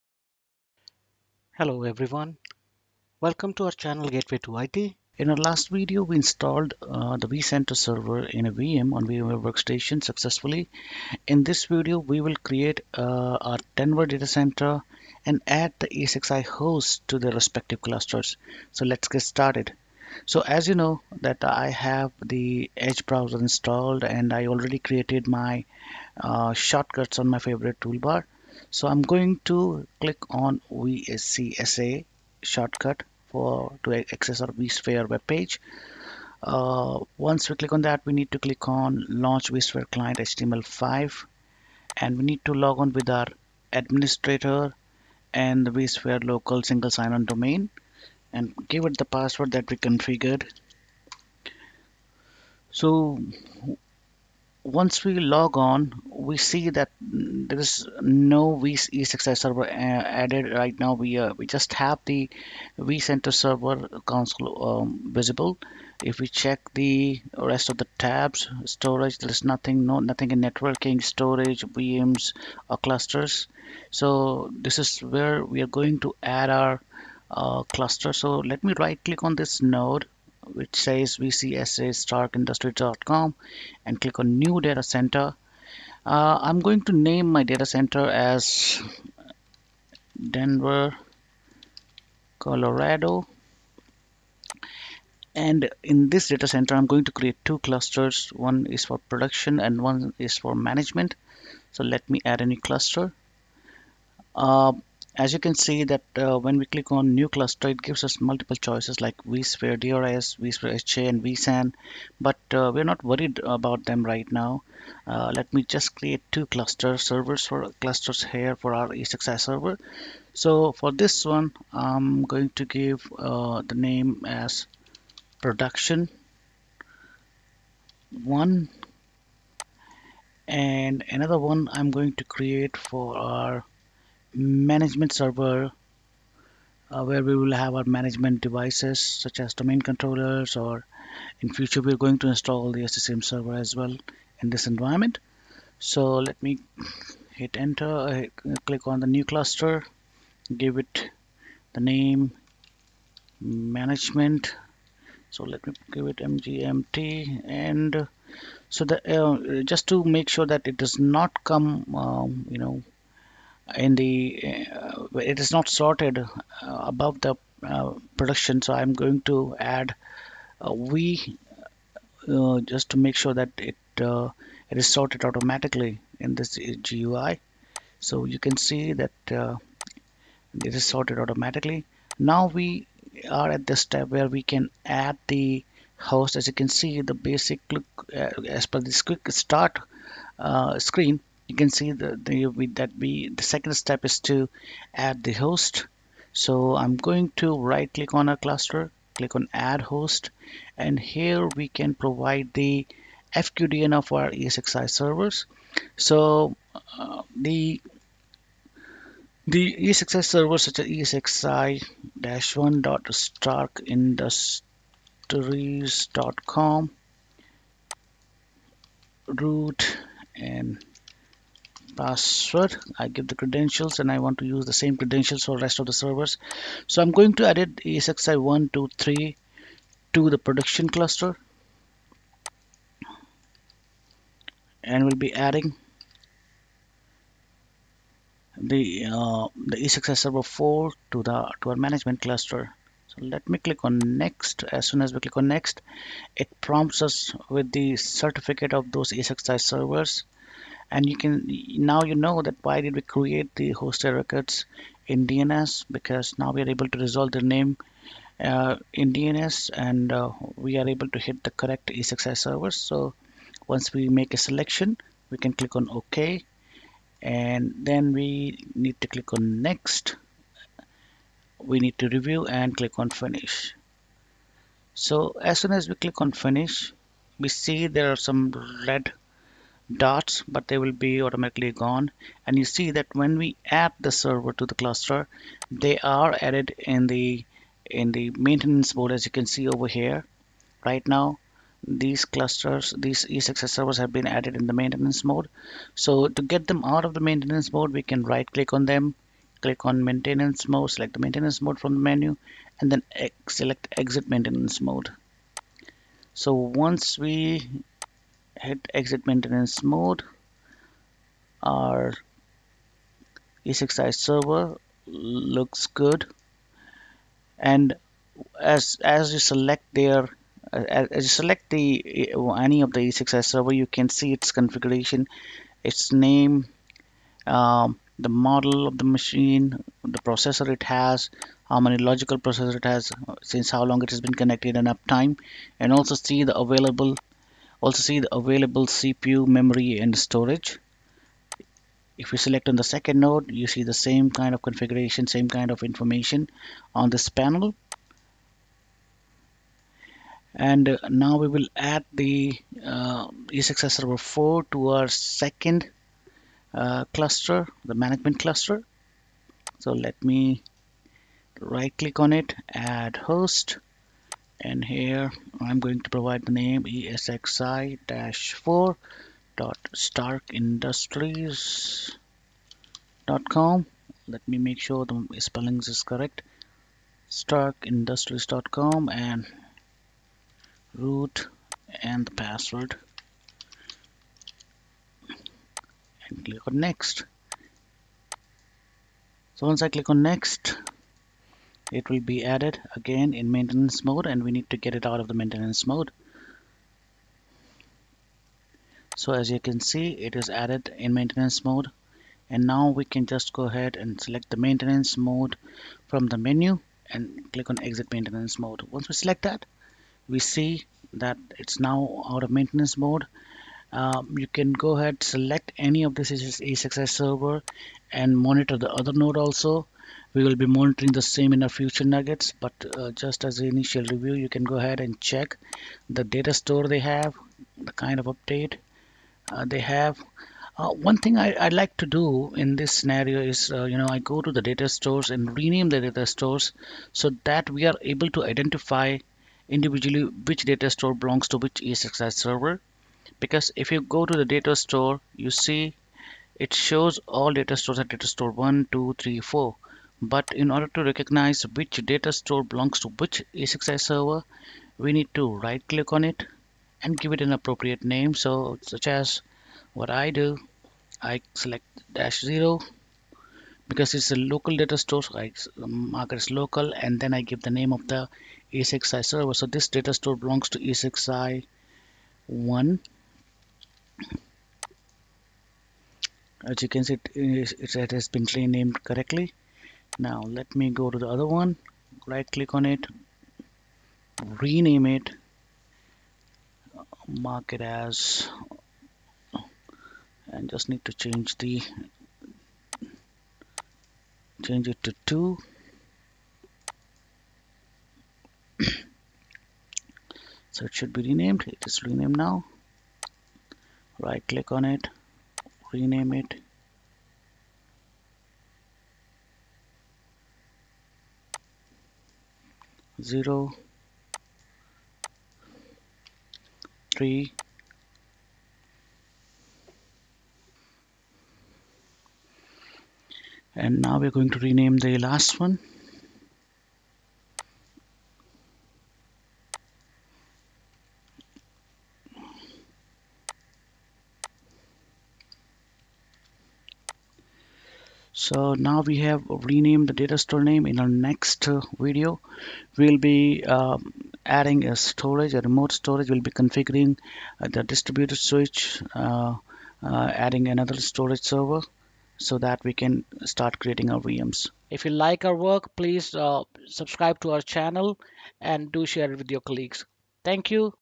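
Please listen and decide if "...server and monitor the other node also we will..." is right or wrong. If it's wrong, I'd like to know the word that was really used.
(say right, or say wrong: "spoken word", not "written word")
right.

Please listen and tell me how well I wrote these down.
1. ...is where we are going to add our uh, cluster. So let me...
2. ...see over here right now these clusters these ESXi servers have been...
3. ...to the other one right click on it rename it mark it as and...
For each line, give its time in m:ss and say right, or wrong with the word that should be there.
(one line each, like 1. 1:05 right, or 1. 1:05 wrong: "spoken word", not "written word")
1. 1:14 right
2. 4:49 right
3. 8:01 right.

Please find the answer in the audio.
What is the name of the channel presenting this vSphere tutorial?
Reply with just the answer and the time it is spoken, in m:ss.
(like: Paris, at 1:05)
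Gateway to IT, at 0:04.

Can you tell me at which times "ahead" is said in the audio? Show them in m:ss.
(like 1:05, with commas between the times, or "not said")
6:43, 6:54, 7:04.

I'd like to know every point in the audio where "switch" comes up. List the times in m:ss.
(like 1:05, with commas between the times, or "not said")
9:08.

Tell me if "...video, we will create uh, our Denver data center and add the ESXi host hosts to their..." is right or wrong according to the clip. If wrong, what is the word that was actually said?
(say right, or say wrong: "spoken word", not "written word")
right.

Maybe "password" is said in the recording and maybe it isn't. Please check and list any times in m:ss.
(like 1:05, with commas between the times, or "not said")
0:49, 3:42, 6:22.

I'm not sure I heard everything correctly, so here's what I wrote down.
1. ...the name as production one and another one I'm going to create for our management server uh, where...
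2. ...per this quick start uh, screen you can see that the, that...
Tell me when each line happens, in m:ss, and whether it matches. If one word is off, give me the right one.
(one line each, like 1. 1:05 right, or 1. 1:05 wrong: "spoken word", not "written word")
1. 2:03 right
2. 3:08 right.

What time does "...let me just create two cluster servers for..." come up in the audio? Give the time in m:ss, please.
1:55.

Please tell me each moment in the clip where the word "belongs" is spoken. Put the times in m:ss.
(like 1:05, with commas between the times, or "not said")
7:21, 7:32, 7:50.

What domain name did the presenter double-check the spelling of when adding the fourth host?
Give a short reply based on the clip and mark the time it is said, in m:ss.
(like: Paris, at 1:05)
starkindustries.com, at 6:17.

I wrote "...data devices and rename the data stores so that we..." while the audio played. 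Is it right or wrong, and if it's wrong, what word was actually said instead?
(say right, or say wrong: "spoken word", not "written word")
wrong: "stores", not "devices".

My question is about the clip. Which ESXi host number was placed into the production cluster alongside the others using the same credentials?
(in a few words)
esxi 3.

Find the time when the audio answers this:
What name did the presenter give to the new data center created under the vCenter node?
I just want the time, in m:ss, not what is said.
1:30.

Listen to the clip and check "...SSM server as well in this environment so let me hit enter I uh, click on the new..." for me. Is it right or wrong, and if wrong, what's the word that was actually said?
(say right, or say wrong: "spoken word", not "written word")
right.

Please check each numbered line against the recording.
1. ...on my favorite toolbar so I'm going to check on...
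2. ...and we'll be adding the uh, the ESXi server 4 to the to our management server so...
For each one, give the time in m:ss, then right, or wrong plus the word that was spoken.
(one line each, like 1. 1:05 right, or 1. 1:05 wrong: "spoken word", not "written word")
1. 0:27 wrong: "click", not "check"
2. 3:54 wrong: "cluster", not "server".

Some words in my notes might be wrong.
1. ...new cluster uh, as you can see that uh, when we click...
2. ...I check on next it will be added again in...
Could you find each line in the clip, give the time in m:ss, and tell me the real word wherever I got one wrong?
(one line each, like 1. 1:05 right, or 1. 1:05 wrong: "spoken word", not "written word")
1. 1:42 right
2. 6:29 wrong: "click", not "check".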